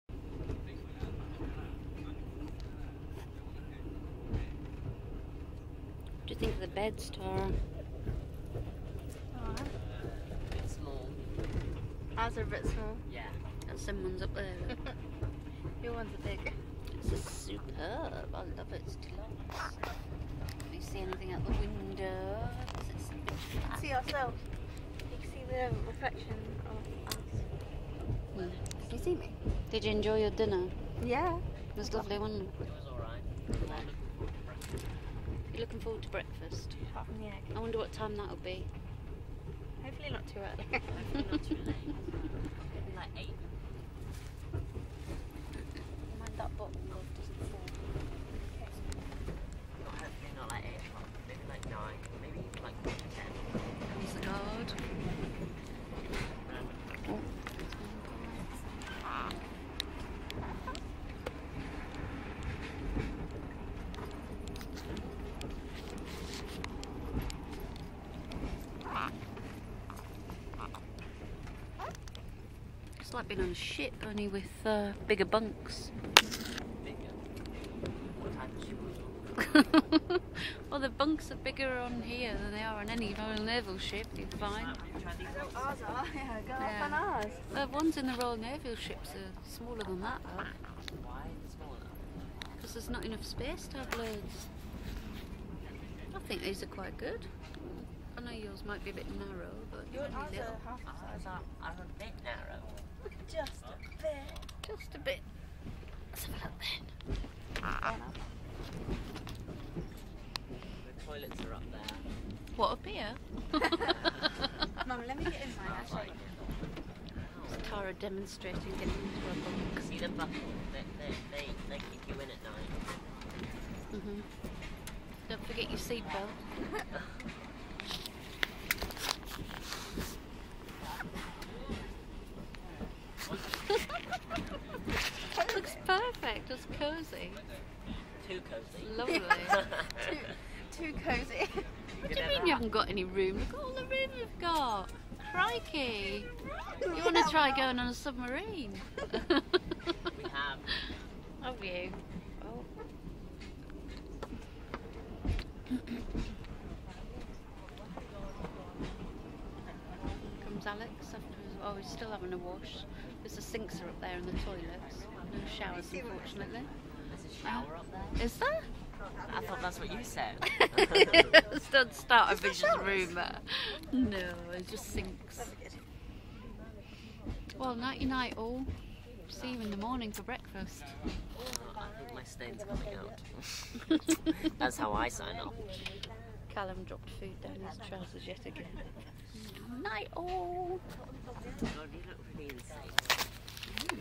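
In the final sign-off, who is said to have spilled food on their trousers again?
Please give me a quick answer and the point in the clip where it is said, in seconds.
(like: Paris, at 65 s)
Callum, at 186 s.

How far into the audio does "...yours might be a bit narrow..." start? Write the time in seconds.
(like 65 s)
98 s.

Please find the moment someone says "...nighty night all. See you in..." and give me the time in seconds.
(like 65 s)
177 s.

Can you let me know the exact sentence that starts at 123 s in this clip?
Mm hmm Don't forget your seatbelt.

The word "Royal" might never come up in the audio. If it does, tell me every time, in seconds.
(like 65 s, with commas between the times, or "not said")
83 s, 88 s.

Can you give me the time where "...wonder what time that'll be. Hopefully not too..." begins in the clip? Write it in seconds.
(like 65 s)
37 s.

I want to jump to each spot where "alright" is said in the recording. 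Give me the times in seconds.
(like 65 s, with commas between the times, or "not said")
9 s, 32 s.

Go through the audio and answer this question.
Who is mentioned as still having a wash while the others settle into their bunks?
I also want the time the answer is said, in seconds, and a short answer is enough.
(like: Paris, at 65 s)
Alex, at 160 s.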